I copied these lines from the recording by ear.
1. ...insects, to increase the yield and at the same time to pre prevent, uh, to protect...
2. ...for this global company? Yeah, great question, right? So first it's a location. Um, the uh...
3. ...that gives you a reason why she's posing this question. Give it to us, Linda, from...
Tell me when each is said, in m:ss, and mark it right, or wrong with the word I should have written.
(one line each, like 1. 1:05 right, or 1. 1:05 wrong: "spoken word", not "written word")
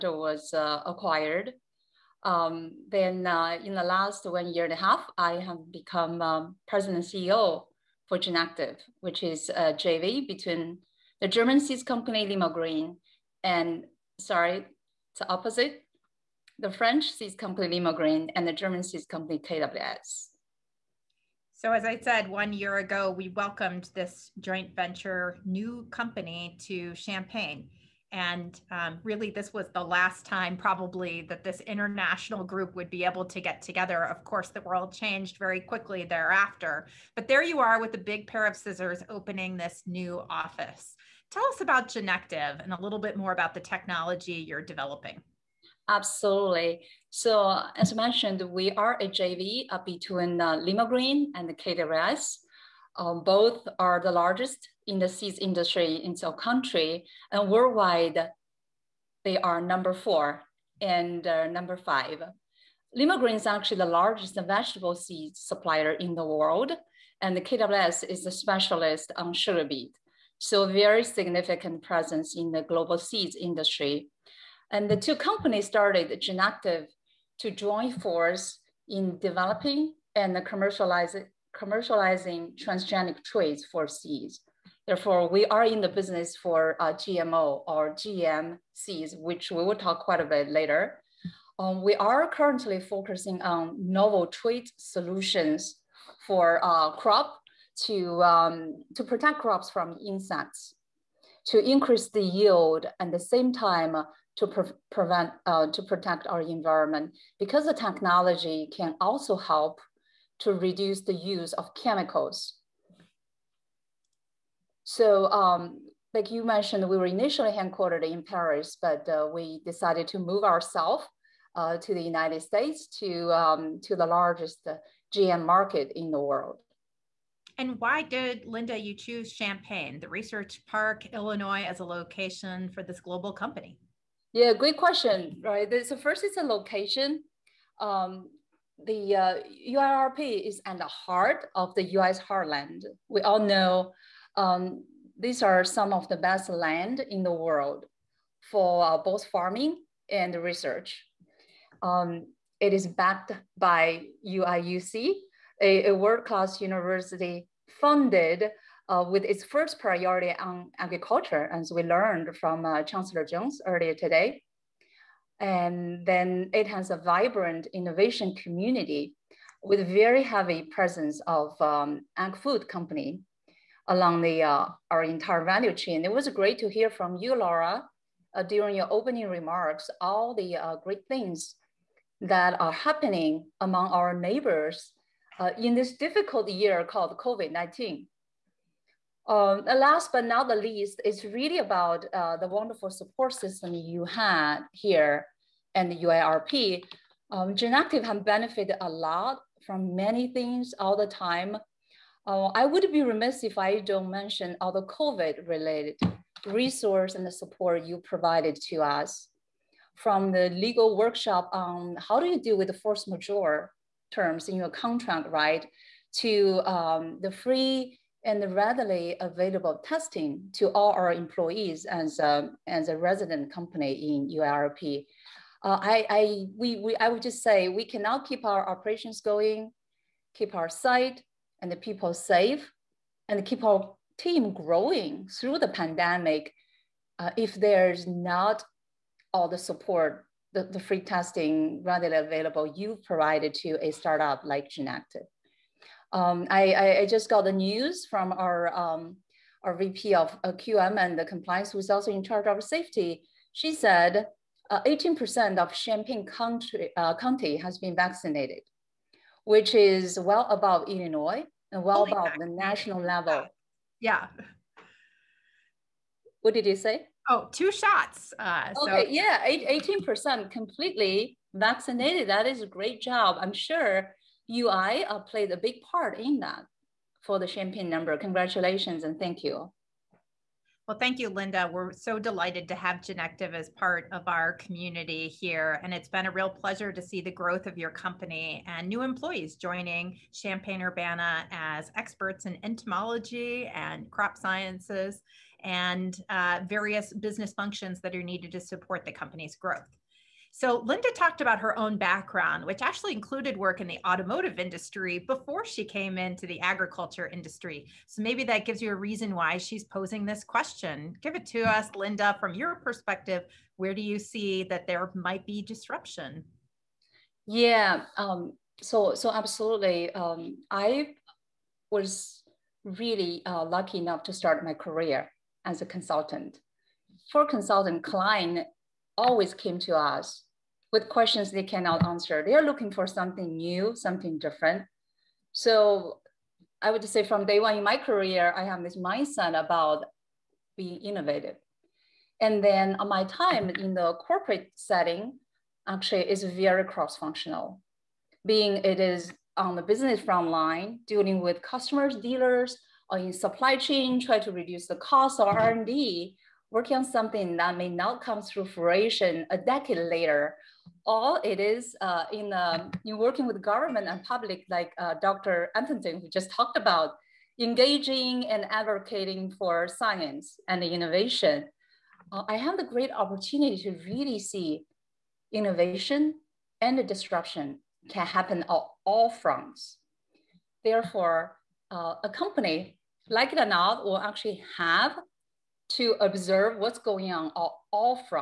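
1. 1:40 right
2. 2:12 right
3. 5:08 right.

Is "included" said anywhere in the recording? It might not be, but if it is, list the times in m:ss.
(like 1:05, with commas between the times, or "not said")
5:03.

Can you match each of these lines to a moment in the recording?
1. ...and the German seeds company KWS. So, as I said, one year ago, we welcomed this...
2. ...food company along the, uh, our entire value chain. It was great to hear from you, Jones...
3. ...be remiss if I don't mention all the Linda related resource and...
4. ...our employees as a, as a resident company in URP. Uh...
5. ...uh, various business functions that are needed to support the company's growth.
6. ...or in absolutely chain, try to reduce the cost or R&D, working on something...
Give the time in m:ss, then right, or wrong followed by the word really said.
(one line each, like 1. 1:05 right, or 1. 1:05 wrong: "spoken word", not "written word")
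1. 0:18 right
2. 2:52 wrong: "Laura", not "Jones"
3. 3:22 wrong: "COVID", not "Linda"
4. 3:40 right
5. 4:56 right
6. 5:53 wrong: "supply", not "absolutely".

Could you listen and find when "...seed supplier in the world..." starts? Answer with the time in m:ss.
1:04.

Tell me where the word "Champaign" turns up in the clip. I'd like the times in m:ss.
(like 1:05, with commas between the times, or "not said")
0:26, 2:09, 4:15, 4:37, 4:50.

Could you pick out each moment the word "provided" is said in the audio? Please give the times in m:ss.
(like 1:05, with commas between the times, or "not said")
3:28, 4:03.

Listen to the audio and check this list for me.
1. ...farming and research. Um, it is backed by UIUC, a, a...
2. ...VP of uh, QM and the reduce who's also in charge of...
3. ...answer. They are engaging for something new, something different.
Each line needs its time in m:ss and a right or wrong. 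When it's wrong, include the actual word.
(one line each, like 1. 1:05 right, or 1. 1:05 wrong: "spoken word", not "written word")
1. 2:29 right
2. 4:09 wrong: "compliance", not "reduce"
3. 5:32 wrong: "looking", not "engaging".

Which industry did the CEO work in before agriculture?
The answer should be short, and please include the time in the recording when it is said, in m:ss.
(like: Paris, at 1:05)
Automotive, at 5:04.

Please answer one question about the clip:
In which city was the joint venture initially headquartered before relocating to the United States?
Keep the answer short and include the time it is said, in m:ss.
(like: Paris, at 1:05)
Paris, at 1:58.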